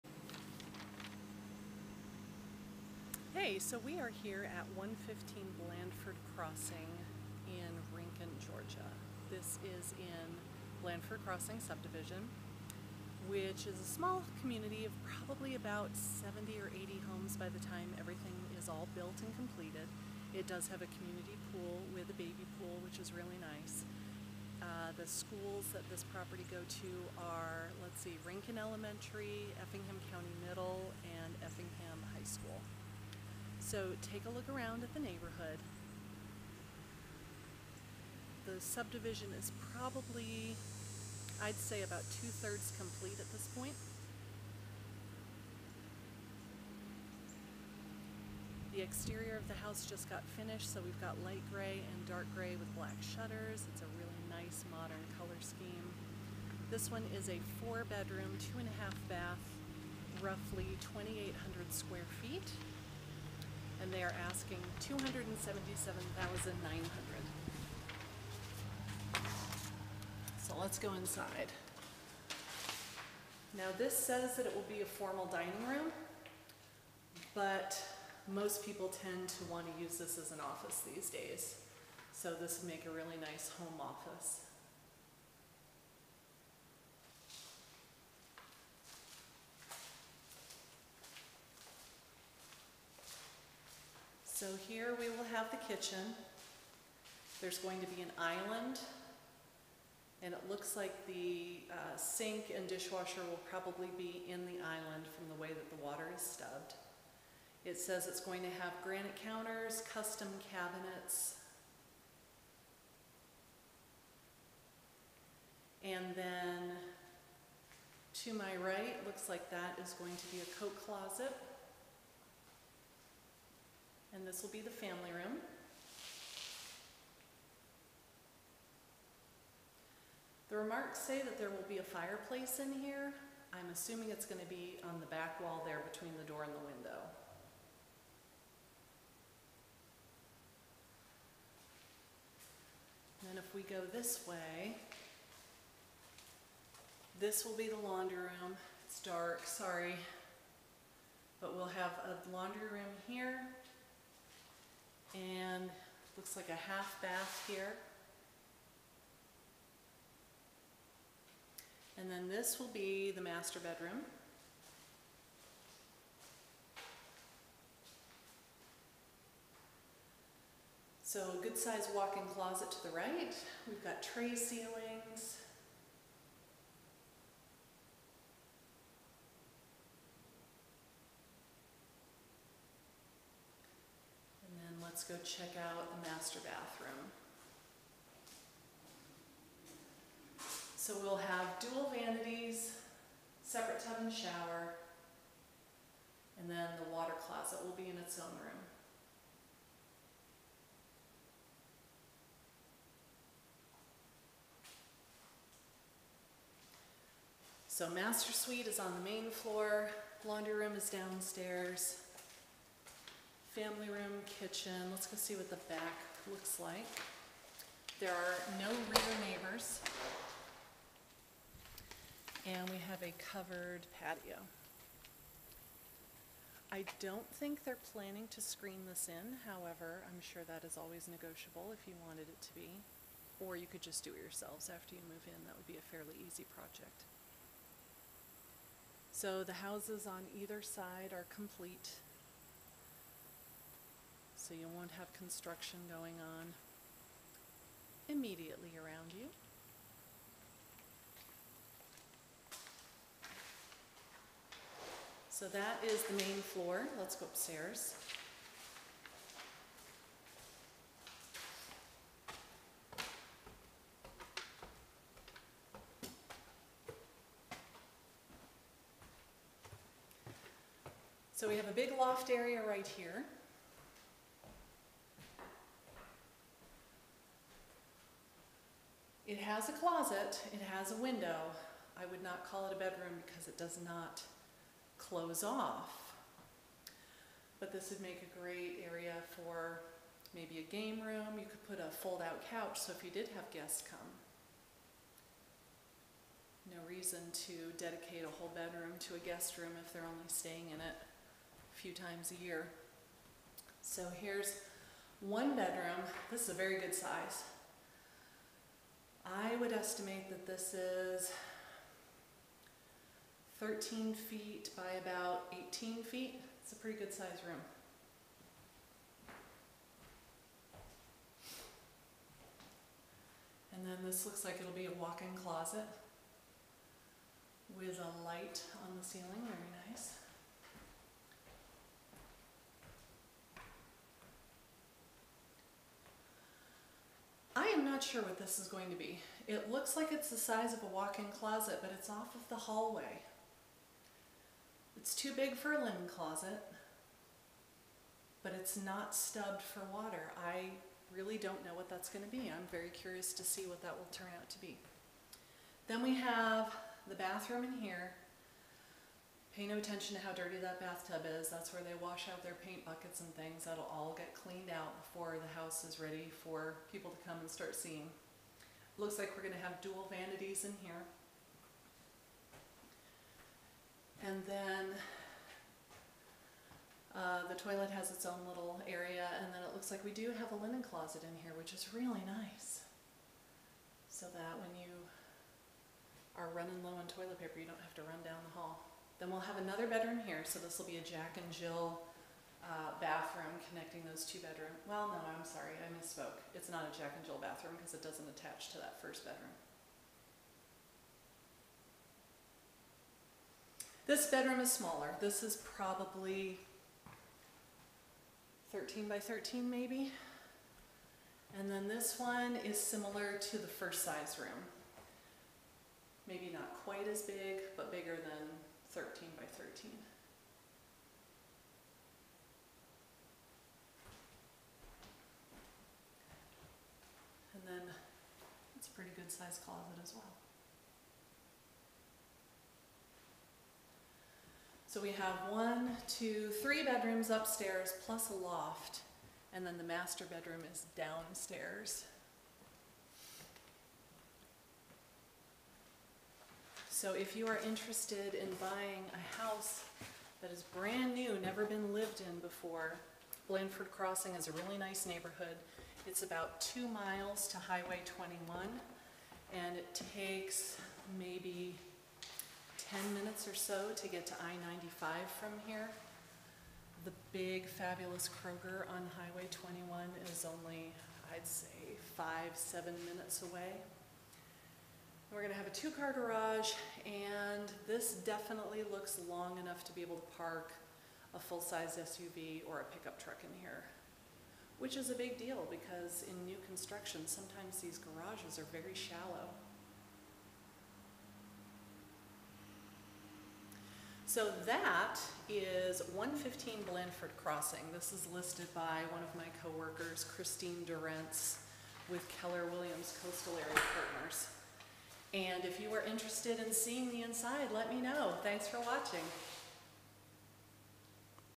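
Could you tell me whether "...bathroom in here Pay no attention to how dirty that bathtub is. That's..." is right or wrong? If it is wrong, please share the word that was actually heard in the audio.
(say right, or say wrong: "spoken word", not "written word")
right.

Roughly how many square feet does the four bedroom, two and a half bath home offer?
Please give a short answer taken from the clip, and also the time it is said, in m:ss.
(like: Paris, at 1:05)
2,800, at 1:00.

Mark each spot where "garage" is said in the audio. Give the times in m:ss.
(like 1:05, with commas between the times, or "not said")
7:56, 8:07.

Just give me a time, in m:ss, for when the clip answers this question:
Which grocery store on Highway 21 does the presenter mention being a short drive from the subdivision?
7:48.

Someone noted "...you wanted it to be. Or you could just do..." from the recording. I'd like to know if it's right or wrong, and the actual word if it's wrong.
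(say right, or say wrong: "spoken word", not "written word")
right.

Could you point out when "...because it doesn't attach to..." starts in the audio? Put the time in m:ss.
6:37.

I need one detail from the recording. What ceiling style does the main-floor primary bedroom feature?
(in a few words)
Tray ceilings.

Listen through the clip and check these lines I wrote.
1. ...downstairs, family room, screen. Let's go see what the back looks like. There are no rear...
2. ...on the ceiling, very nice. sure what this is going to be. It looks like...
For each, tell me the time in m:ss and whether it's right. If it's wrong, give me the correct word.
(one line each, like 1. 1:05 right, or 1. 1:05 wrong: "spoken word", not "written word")
1. 3:30 wrong: "kitchen", not "screen"
2. 5:28 right.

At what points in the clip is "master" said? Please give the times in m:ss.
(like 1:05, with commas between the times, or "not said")
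2:43, 3:06, 3:27, 7:19.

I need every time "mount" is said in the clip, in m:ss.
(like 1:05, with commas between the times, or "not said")
not said.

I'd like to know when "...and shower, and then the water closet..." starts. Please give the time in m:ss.
3:14.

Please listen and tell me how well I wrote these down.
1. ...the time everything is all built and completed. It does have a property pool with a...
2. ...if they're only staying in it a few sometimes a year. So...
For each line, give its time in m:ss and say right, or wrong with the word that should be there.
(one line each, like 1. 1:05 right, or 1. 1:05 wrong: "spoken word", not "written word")
1. 0:17 wrong: "community", not "property"
2. 4:59 wrong: "times", not "sometimes".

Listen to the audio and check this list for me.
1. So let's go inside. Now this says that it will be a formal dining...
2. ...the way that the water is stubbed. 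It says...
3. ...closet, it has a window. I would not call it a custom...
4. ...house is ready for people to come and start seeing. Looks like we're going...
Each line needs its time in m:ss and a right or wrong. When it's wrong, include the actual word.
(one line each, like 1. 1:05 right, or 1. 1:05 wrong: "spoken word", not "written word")
1. 1:10 right
2. 1:45 right
3. 4:39 wrong: "bedroom", not "custom"
4. 6:05 right.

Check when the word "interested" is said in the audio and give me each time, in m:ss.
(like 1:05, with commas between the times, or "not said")
7:27, 8:26.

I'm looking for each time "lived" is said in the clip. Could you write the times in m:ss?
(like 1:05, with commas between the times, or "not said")
7:31.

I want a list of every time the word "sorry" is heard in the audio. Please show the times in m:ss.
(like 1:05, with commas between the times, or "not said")
2:29, 6:35.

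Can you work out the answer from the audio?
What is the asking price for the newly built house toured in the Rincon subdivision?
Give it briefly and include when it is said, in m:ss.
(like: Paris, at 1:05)
$277,900, at 1:04.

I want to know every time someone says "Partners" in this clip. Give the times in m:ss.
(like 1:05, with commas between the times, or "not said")
8:24.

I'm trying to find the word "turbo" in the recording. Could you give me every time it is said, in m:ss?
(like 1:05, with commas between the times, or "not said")
not said.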